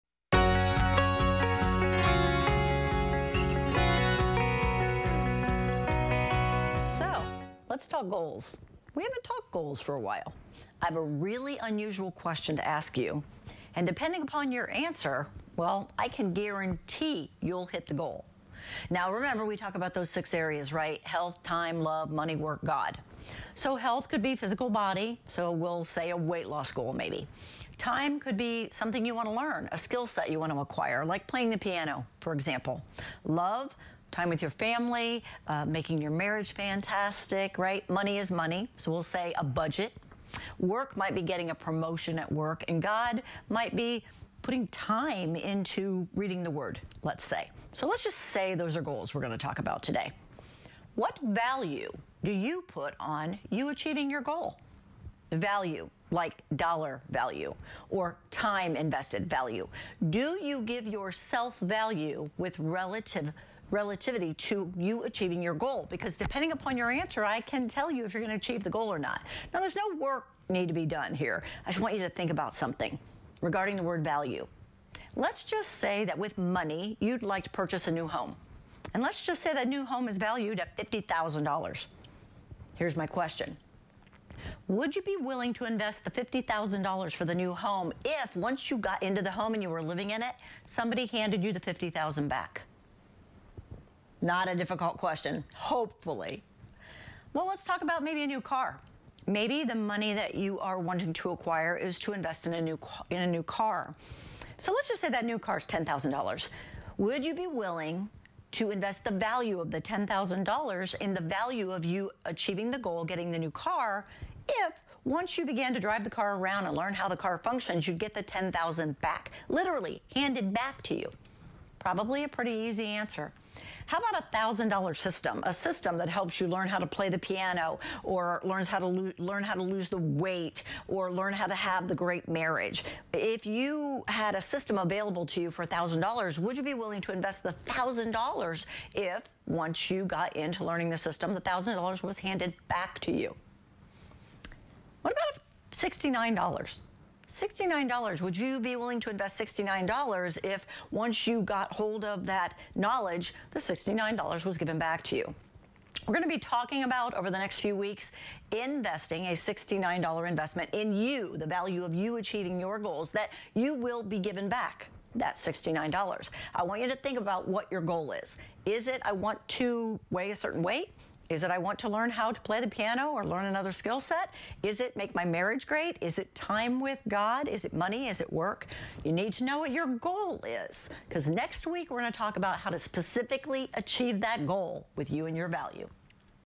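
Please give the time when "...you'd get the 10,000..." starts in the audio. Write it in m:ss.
1:57.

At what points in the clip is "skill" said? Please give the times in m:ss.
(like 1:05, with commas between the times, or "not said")
0:29, 2:53.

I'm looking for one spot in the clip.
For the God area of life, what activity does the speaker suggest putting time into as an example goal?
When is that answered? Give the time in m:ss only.
0:46.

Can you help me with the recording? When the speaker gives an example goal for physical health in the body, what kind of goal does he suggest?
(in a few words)
weight loss goal.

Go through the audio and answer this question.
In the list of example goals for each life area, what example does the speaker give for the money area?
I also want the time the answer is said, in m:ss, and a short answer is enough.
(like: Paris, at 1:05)
a budget, at 0:39.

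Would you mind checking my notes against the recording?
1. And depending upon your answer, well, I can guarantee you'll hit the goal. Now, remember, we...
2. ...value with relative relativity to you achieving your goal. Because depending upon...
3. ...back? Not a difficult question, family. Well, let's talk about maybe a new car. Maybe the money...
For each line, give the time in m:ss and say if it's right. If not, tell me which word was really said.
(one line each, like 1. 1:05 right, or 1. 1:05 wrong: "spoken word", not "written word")
1. 0:13 right
2. 1:01 right
3. 1:32 wrong: "hopefully", not "family".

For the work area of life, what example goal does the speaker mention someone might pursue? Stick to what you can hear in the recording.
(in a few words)
getting a promotion.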